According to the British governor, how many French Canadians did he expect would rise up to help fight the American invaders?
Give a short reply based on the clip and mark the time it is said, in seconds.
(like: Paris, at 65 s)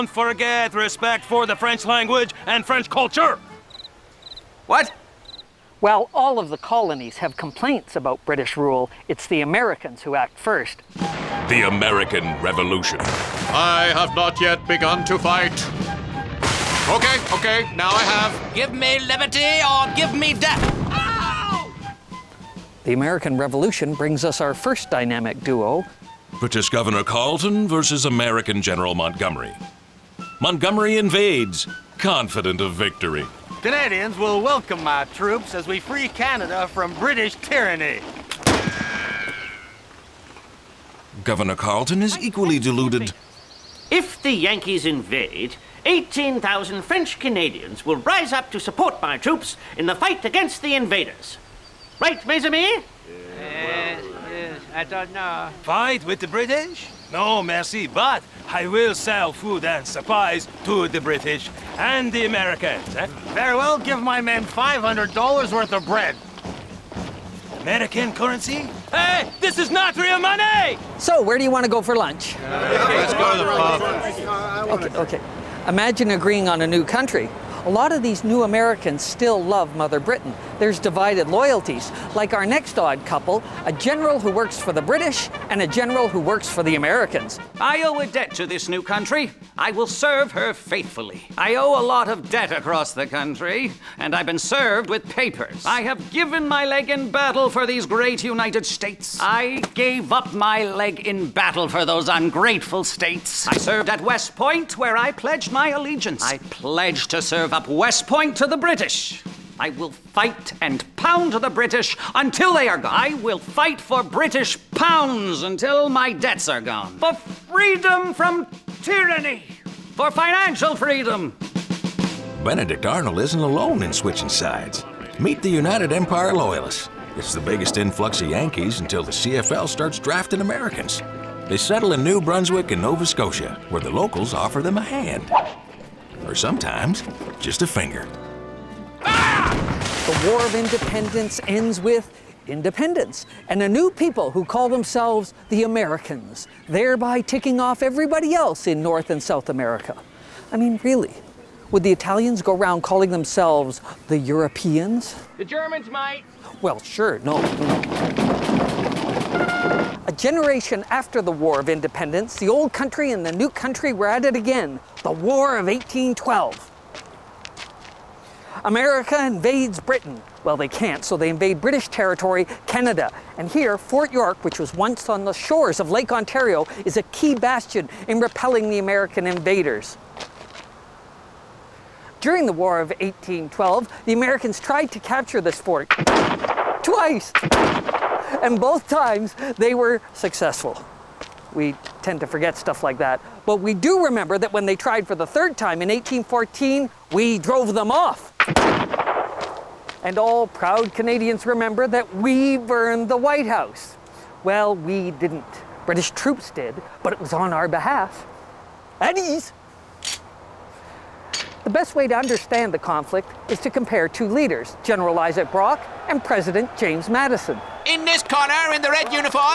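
18,000, at 45 s.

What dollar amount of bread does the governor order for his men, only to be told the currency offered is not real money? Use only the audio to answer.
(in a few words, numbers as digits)
$500.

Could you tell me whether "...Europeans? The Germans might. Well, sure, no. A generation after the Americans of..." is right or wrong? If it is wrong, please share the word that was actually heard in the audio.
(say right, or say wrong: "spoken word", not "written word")
wrong: "War", not "Americans".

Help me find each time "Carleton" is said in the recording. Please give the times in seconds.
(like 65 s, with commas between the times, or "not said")
27 s, 41 s.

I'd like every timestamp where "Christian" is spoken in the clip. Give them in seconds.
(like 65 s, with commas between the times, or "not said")
not said.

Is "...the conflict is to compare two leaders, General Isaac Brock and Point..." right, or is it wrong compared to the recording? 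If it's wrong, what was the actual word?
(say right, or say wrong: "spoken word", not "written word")
wrong: "President", not "Point".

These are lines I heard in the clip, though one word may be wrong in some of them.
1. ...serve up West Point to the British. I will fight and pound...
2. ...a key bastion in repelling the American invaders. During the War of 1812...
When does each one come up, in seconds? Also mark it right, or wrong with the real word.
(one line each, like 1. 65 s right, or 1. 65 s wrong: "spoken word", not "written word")
1. 107 s right
2. 176 s right.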